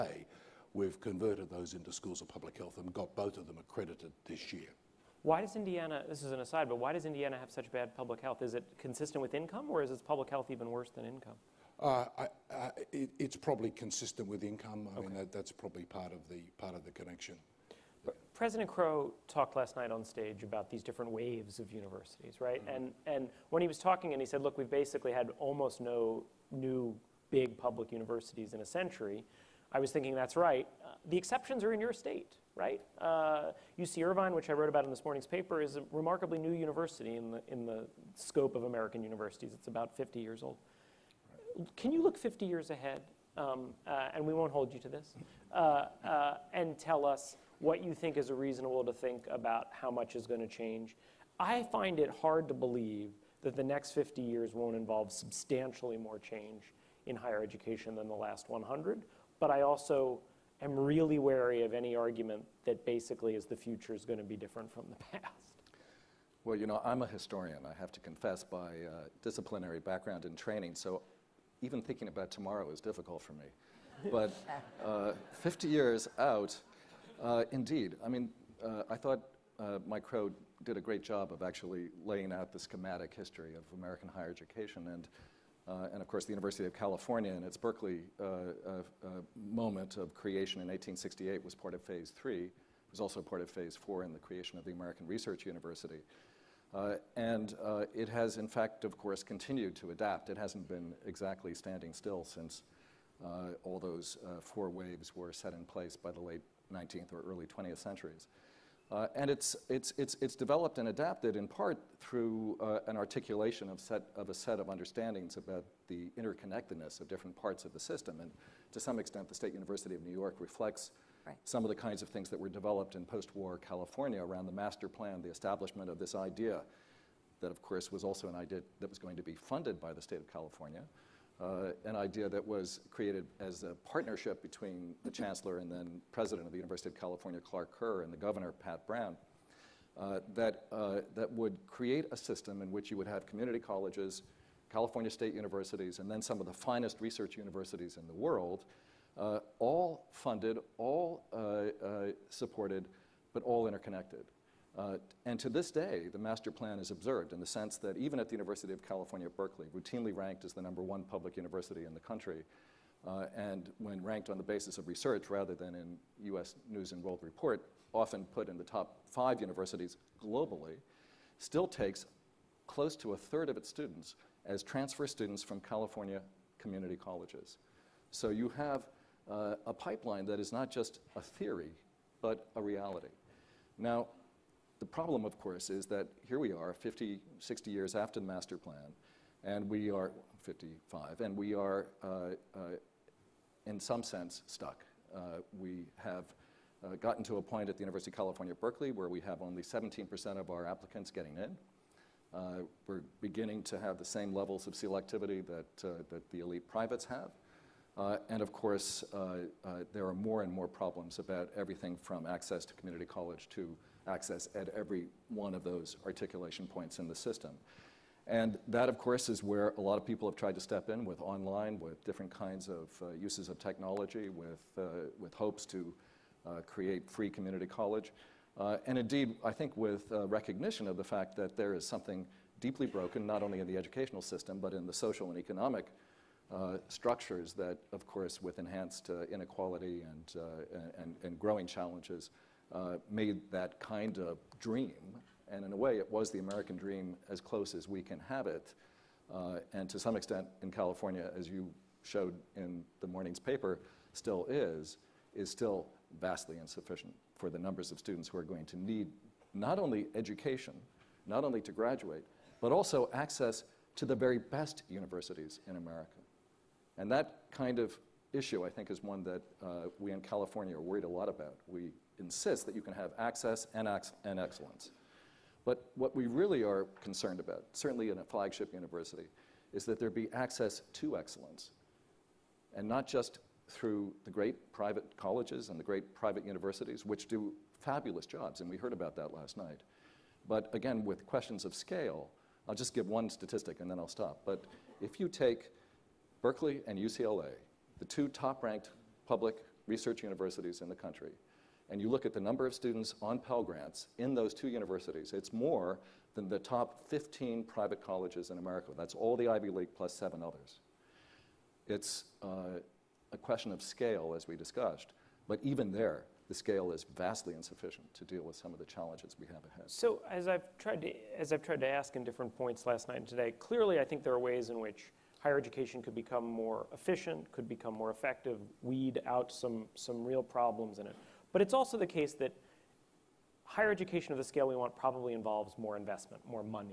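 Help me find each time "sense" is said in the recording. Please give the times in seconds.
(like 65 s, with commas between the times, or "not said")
157 s, 194 s.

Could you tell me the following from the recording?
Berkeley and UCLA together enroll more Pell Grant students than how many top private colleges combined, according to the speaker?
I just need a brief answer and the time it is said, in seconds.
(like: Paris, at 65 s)
15, at 306 s.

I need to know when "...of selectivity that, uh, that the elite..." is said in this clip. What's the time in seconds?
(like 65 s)
204 s.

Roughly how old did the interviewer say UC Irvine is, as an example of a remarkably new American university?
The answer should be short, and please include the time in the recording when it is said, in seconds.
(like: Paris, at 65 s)
50 years, at 39 s.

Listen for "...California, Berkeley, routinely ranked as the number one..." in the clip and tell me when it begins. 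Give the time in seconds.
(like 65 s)
158 s.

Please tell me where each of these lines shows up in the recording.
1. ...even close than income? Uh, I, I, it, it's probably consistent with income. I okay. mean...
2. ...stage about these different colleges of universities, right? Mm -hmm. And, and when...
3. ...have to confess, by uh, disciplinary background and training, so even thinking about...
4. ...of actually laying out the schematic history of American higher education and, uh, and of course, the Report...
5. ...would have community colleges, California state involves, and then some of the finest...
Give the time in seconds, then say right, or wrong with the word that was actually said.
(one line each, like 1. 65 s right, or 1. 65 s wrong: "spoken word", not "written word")
1. 10 s wrong: "worse", not "close"
2. 20 s wrong: "waves", not "colleges"
3. 67 s right
4. 81 s wrong: "University", not "Report"
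5. 142 s wrong: "universities", not "involves".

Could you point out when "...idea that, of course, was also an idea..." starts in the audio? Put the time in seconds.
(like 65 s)
126 s.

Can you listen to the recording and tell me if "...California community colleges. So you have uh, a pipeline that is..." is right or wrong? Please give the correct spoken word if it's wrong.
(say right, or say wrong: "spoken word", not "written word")
right.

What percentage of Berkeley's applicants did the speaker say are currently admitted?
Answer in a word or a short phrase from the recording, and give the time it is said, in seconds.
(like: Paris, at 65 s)
17%, at 199 s.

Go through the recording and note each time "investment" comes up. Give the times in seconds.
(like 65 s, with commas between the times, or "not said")
335 s.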